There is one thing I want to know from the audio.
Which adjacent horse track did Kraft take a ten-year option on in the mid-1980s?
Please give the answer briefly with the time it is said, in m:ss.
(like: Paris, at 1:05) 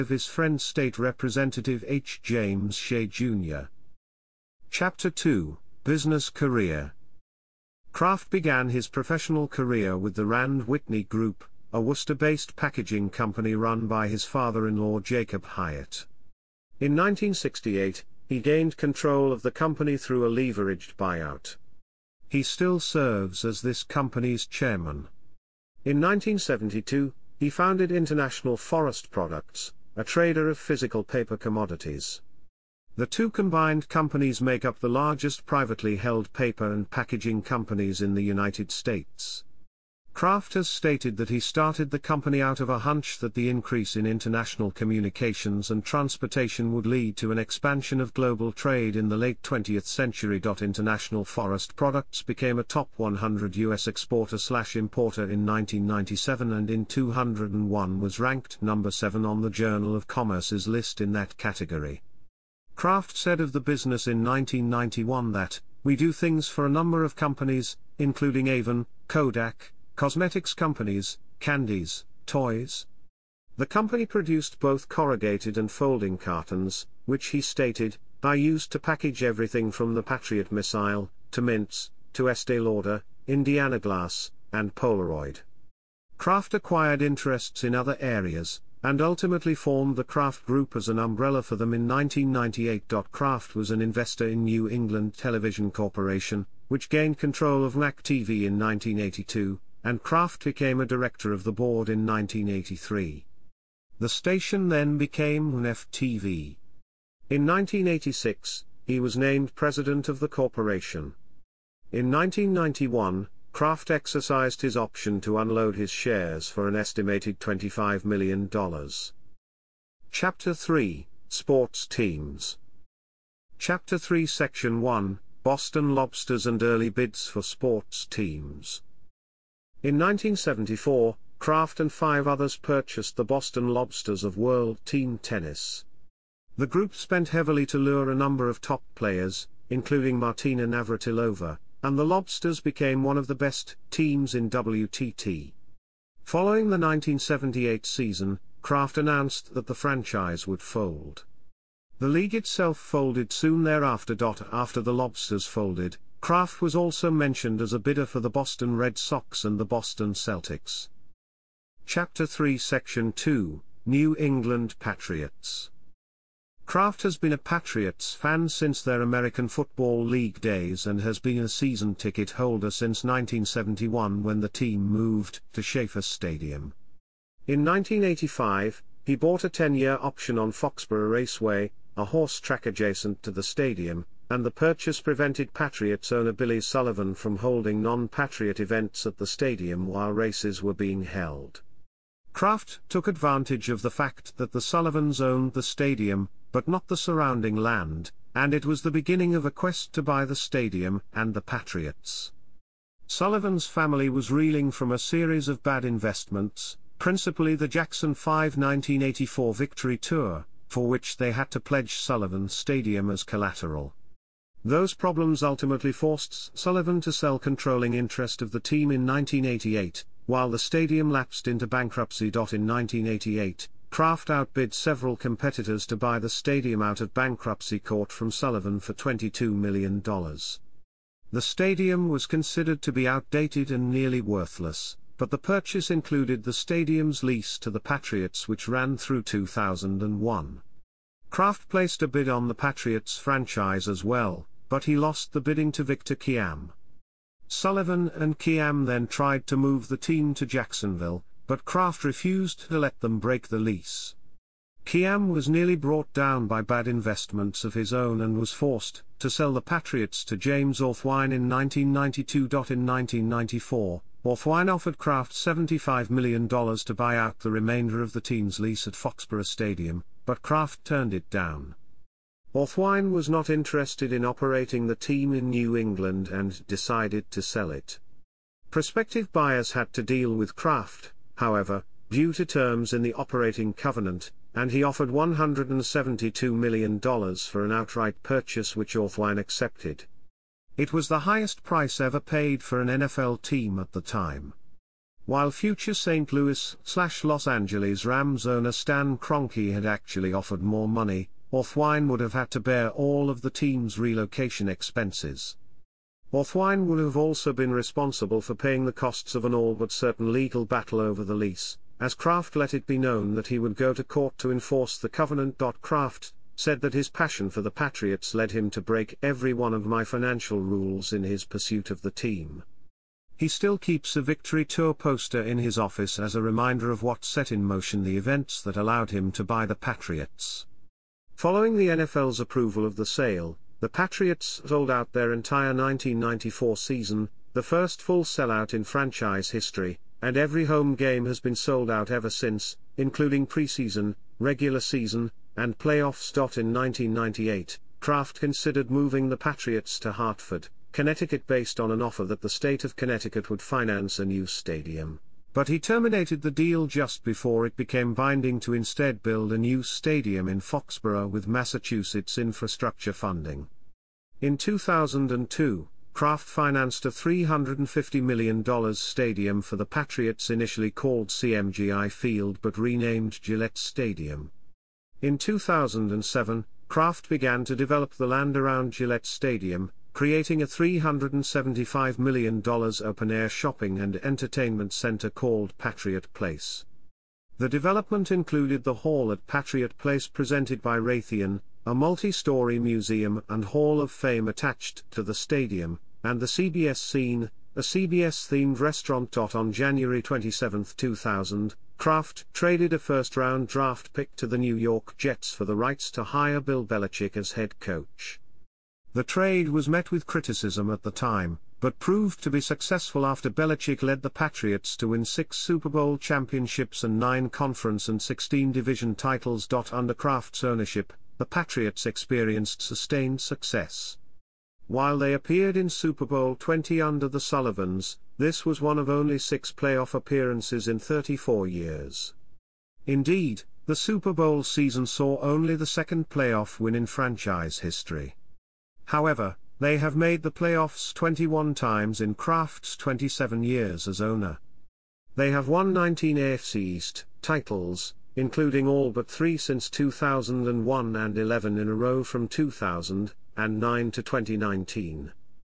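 Foxborough Raceway, at 3:00.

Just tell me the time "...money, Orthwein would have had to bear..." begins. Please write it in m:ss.
5:00.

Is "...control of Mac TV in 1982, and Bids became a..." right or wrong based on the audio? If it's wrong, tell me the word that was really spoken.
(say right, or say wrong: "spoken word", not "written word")
wrong: "Kraft", not "Bids".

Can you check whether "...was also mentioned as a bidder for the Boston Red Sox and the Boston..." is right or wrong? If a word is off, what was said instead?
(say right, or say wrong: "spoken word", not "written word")
right.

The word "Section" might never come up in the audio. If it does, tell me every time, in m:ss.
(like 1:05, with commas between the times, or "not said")
2:04, 2:42.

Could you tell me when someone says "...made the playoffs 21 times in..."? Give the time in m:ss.
7:20.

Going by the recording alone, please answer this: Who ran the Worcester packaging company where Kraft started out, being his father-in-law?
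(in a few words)
Jacob Hyatt.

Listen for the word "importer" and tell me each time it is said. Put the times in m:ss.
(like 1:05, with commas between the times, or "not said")
0:54.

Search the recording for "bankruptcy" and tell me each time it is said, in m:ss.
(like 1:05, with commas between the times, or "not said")
3:41, 3:47.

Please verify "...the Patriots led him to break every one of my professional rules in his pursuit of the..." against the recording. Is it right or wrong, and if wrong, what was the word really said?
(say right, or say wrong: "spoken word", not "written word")
wrong: "financial", not "professional".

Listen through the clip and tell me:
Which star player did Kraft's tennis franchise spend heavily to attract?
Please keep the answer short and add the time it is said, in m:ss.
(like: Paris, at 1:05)
Martina Navratilova, at 2:20.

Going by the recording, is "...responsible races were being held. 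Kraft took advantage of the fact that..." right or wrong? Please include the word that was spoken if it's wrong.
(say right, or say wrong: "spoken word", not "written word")
wrong: "while", not "responsible".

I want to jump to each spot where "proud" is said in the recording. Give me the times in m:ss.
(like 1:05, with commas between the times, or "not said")
not said.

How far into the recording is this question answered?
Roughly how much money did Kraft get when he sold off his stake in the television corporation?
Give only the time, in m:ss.
1:57.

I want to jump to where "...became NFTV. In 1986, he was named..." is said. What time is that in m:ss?
1:44.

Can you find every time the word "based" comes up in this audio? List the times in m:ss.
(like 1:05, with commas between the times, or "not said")
0:11, 5:51.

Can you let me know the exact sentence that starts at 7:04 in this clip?
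While they appeared in Super Bowl 20 under the Sullivans, this was one of only six playoff appearances in 34 years.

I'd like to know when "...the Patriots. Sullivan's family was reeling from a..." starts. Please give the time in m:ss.
3:21.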